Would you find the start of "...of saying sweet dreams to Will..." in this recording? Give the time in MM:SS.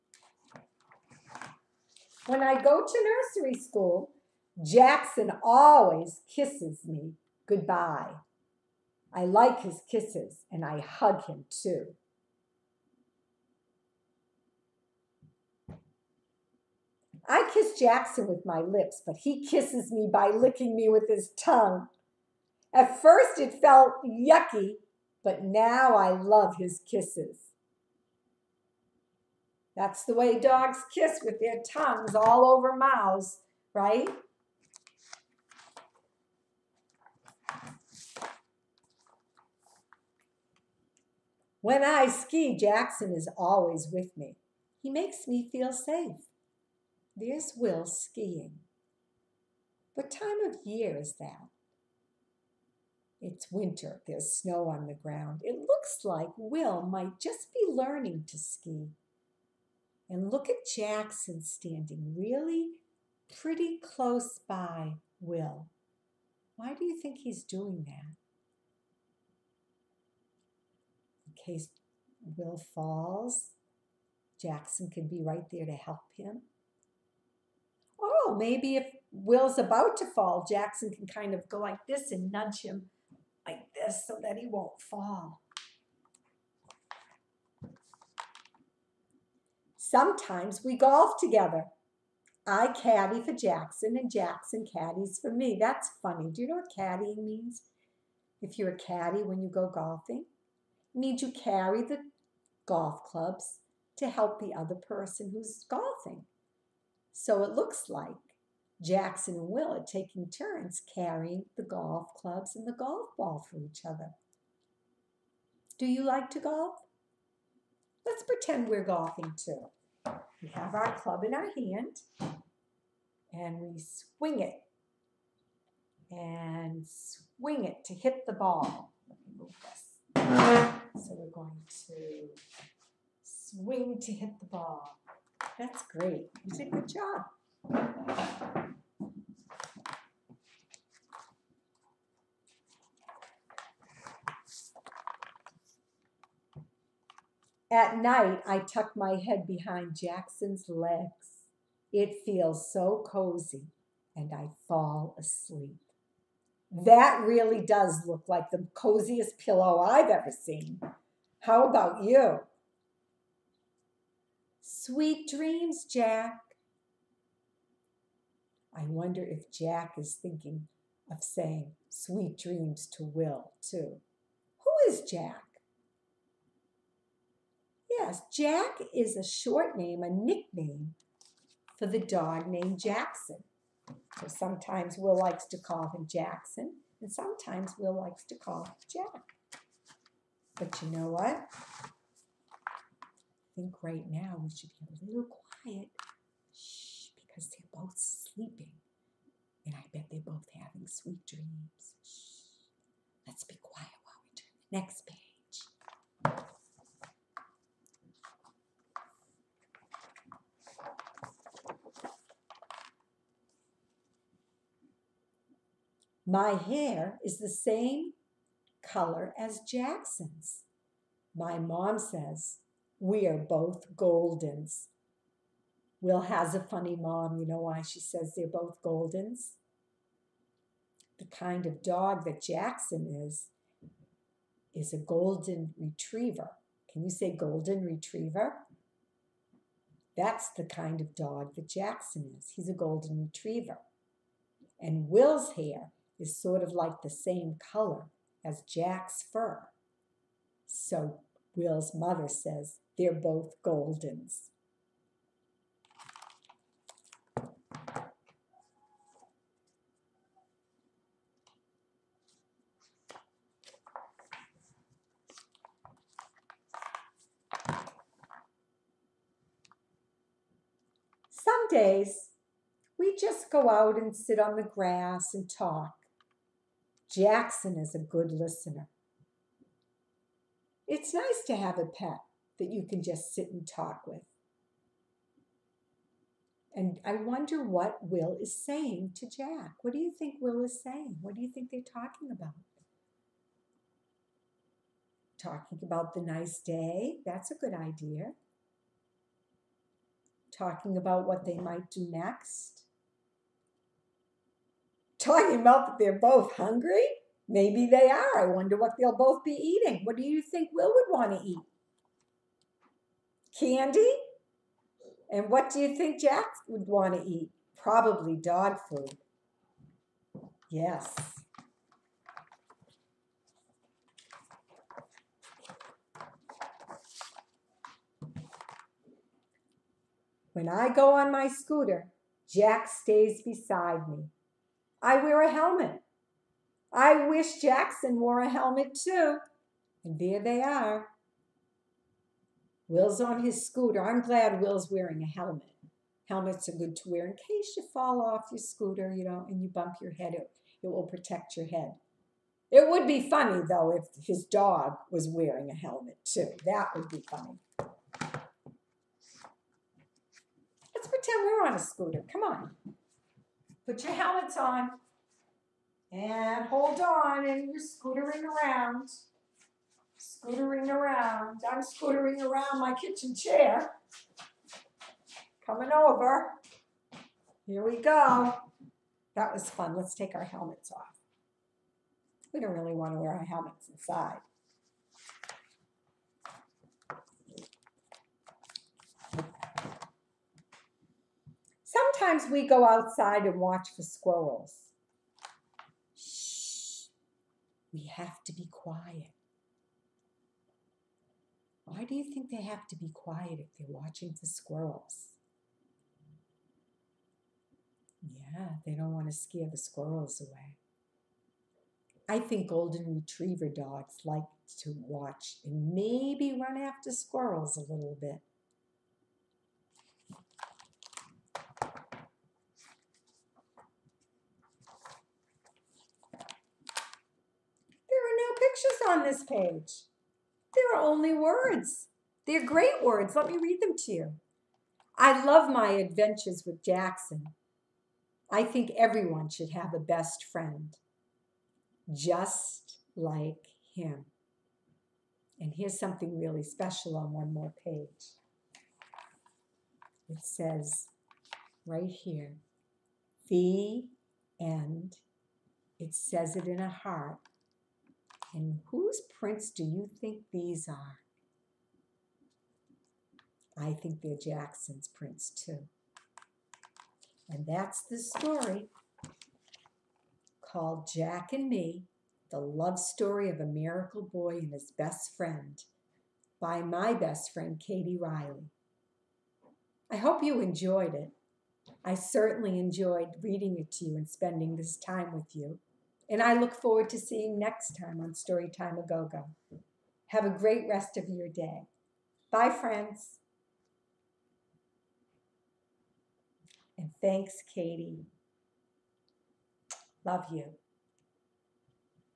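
02:51.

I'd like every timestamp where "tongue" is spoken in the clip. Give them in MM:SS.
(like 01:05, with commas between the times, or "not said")
00:21, 00:31.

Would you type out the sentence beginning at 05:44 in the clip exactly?
I'm glad Will's wearing a helmet.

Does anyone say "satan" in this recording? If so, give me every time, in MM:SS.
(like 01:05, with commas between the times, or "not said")
not said.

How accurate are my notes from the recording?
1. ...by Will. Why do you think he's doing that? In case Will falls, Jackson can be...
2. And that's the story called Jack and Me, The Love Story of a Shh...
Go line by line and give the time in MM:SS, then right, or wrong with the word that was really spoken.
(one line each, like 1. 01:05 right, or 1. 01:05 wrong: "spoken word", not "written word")
1. 01:04 right
2. 07:47 wrong: "Miracle", not "Shh".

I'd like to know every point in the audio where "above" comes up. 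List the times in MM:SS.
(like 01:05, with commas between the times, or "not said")
not said.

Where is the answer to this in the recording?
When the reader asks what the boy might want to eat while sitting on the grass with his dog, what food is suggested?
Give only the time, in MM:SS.
05:13.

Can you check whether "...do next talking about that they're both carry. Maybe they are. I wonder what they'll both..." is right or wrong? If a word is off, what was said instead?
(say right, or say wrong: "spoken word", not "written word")
wrong: "hungry", not "carry".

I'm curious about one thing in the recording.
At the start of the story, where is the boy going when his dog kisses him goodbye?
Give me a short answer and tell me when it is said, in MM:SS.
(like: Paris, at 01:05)
nursery school, at 00:03.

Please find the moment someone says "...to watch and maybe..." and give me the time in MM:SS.
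06:54.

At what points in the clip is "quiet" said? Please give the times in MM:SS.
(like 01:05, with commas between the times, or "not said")
03:15, 03:23, 06:38, 06:43.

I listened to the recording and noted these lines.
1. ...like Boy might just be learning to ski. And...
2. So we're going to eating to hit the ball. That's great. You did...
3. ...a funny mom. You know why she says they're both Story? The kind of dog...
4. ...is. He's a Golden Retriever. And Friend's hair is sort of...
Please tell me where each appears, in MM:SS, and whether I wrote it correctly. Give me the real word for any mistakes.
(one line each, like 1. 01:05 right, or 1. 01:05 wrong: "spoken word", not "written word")
1. 00:56 wrong: "Will", not "Boy"
2. 02:11 wrong: "swing", not "eating"
3. 03:46 wrong: "Goldens", not "Story"
4. 04:02 wrong: "Will", not "Friend".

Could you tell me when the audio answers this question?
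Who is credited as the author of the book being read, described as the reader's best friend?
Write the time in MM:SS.
07:57.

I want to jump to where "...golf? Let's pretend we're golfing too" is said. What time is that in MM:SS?
01:56.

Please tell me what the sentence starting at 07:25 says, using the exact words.
And here's something really special on one more page.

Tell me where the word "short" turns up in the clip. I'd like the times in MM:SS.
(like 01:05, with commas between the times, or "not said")
02:59.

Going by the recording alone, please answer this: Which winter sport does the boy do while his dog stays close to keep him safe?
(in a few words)
skiing.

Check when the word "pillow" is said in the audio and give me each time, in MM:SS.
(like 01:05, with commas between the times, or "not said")
02:39.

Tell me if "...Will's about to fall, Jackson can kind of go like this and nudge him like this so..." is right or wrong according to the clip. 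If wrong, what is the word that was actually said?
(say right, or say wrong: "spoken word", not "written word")
right.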